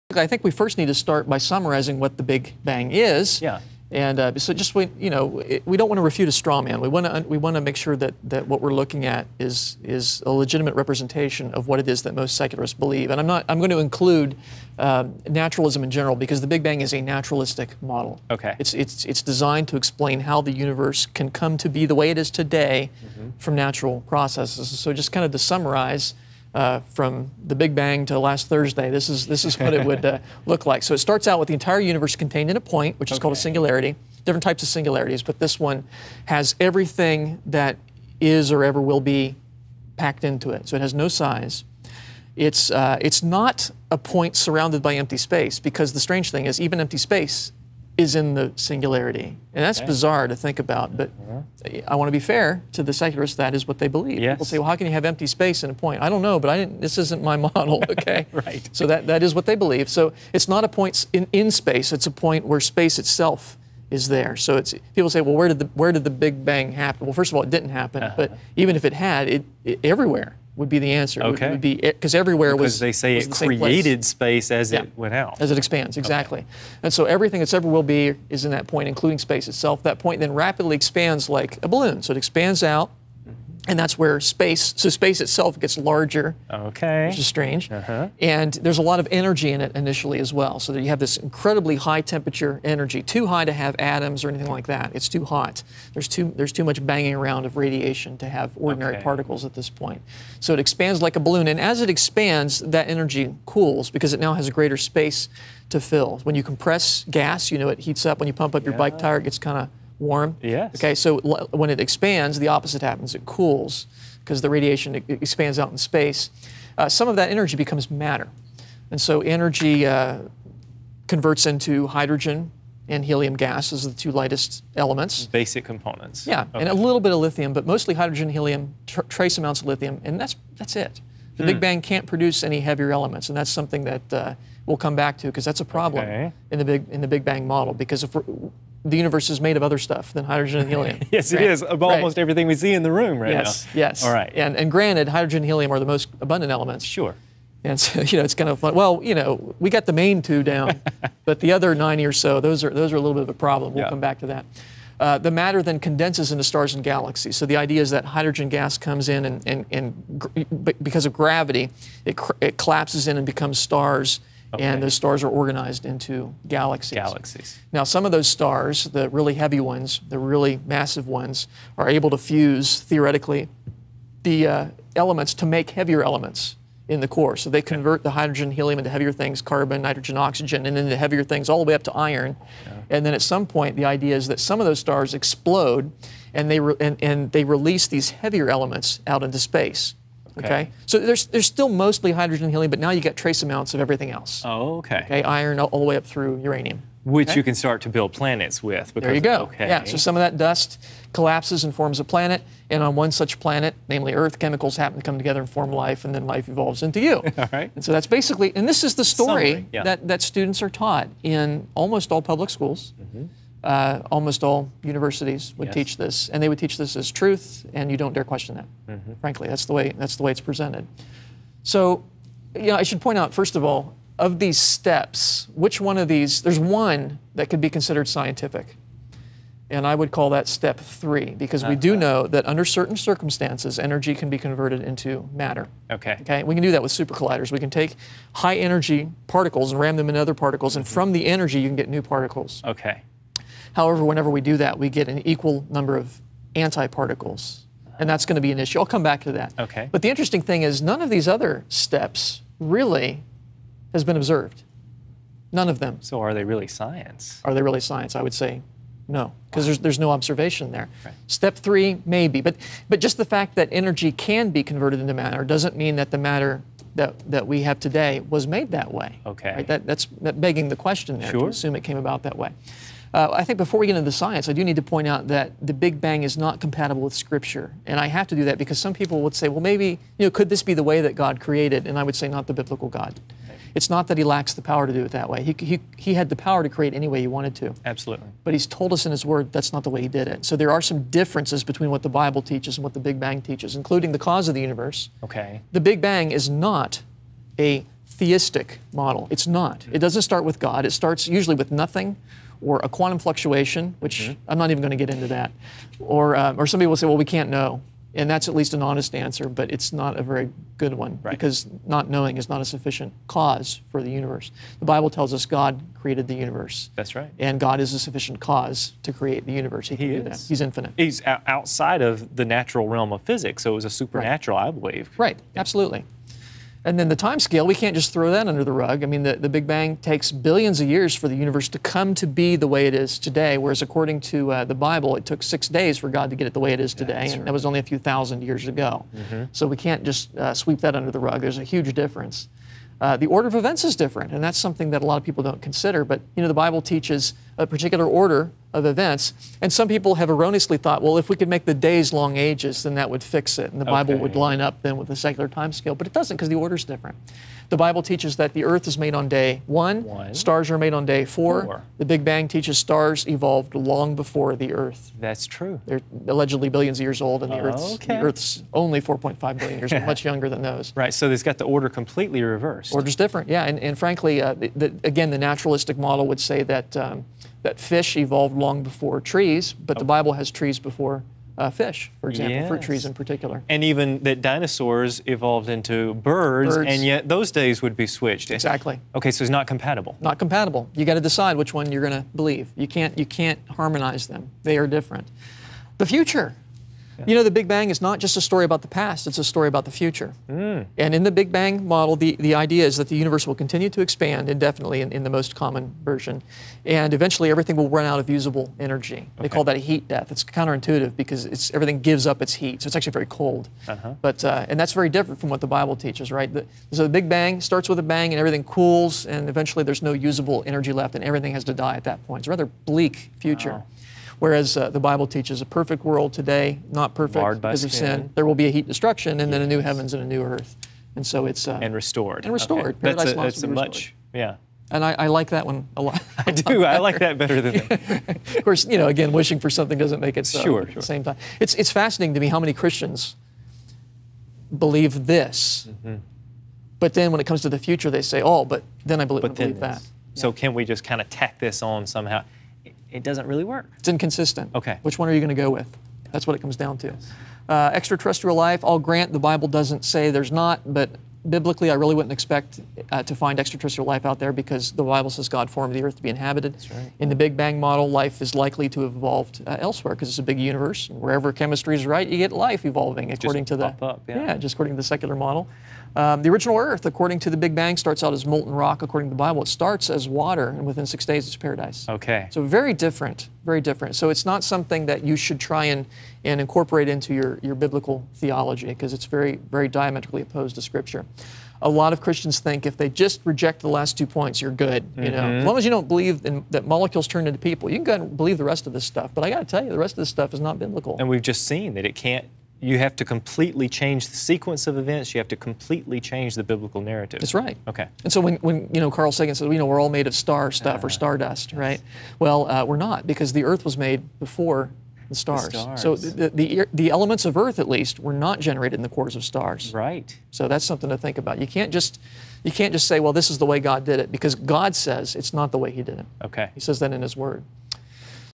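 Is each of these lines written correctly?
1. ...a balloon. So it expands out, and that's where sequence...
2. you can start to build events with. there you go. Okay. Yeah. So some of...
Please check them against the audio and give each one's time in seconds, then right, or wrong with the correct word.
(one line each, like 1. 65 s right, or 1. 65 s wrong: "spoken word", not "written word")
1. 81 s wrong: "space", not "sequence"
2. 197 s wrong: "planets", not "events".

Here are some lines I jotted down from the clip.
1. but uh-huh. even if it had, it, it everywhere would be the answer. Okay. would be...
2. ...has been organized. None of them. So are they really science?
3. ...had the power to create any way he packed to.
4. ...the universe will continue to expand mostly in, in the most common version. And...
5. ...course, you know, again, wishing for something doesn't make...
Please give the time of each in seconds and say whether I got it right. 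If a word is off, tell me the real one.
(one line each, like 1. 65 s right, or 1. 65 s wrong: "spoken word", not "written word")
1. 68 s right
2. 253 s wrong: "observed", not "organized"
3. 286 s wrong: "wanted", not "packed"
4. 403 s wrong: "indefinitely", not "mostly"
5. 438 s right.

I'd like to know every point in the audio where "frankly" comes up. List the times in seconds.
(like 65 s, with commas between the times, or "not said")
219 s, 373 s.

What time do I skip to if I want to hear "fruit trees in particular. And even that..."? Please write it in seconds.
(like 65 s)
382 s.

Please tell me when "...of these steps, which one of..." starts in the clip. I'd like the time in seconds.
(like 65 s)
224 s.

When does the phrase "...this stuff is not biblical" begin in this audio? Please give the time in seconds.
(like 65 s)
500 s.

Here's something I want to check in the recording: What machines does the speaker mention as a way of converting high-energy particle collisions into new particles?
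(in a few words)
super colliders.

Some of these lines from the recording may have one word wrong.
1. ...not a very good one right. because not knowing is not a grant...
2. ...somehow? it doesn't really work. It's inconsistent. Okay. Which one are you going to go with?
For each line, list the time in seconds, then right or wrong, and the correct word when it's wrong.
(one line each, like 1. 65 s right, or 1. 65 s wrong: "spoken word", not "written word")
1. 309 s wrong: "sufficient", not "grant"
2. 452 s right.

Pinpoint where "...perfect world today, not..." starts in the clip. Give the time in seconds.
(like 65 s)
425 s.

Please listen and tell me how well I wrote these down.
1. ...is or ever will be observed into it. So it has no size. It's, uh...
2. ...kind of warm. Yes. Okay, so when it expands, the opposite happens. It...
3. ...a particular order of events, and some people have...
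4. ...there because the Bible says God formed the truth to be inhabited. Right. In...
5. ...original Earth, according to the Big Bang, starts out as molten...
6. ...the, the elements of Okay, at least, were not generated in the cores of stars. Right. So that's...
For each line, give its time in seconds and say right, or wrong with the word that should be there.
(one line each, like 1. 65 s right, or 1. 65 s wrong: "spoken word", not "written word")
1. 38 s wrong: "packed", not "observed"
2. 109 s right
3. 347 s right
4. 464 s wrong: "earth", not "truth"
5. 476 s right
6. 516 s wrong: "Earth", not "Okay".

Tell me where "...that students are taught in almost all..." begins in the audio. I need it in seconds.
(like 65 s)
210 s.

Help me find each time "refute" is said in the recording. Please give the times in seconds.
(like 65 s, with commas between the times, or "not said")
6 s.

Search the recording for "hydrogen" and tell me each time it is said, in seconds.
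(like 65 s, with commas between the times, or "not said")
121 s, 127 s, 140 s, 145 s, 158 s, 178 s, 192 s.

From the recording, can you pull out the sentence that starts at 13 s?
And I'm, not, I'm going to include uh, naturalism in general because the Big Bang is a naturalistic model.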